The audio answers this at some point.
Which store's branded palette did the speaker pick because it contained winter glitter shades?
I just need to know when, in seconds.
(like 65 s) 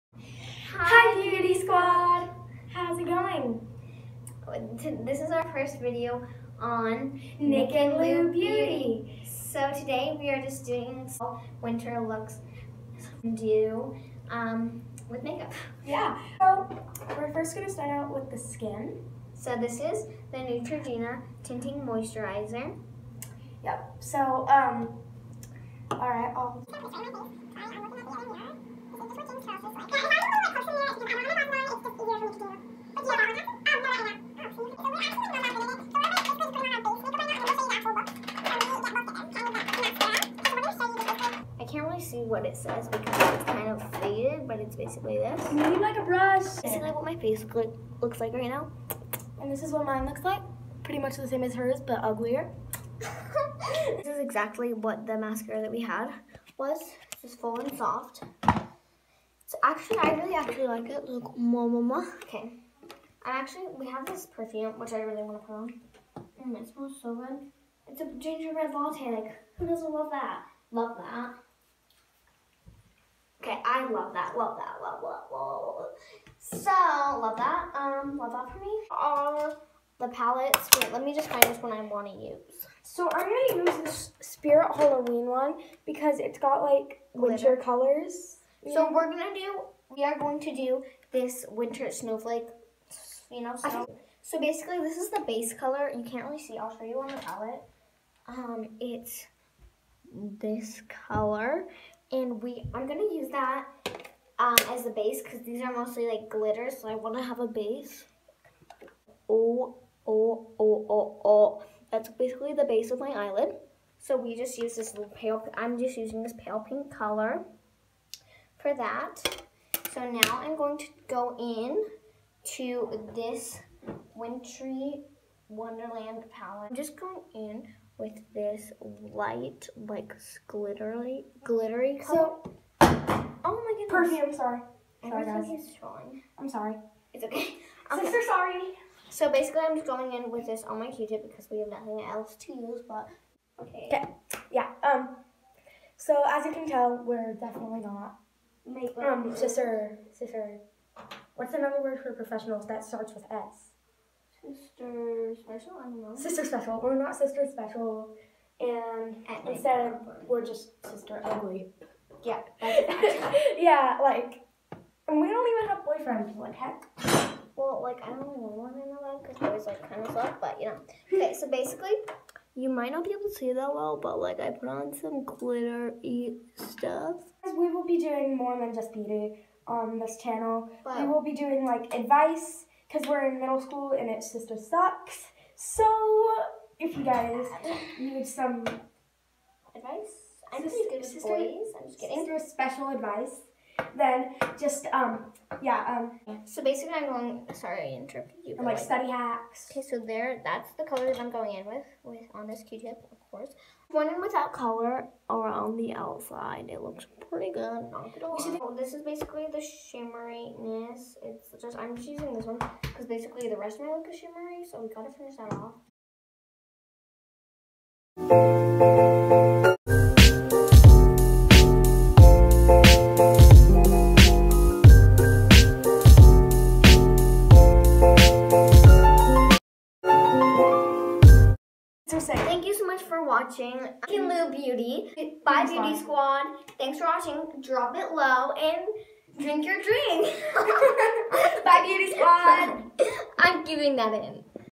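84 s.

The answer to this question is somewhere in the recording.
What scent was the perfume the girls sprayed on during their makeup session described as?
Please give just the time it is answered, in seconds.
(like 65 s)
68 s.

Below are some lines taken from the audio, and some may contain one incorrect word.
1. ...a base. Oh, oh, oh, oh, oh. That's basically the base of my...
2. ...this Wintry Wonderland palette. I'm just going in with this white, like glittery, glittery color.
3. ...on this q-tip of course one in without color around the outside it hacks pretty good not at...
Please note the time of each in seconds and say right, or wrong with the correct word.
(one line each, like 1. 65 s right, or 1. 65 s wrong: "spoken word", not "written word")
1. 107 s right
2. 123 s right
3. 202 s wrong: "looks", not "hacks".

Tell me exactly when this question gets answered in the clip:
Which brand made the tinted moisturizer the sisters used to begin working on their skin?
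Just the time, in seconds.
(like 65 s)
20 s.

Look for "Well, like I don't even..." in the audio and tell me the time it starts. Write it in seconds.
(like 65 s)
167 s.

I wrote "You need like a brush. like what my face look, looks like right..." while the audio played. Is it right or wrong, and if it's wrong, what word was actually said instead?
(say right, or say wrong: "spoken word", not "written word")
right.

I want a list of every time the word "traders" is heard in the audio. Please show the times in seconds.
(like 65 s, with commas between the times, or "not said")
not said.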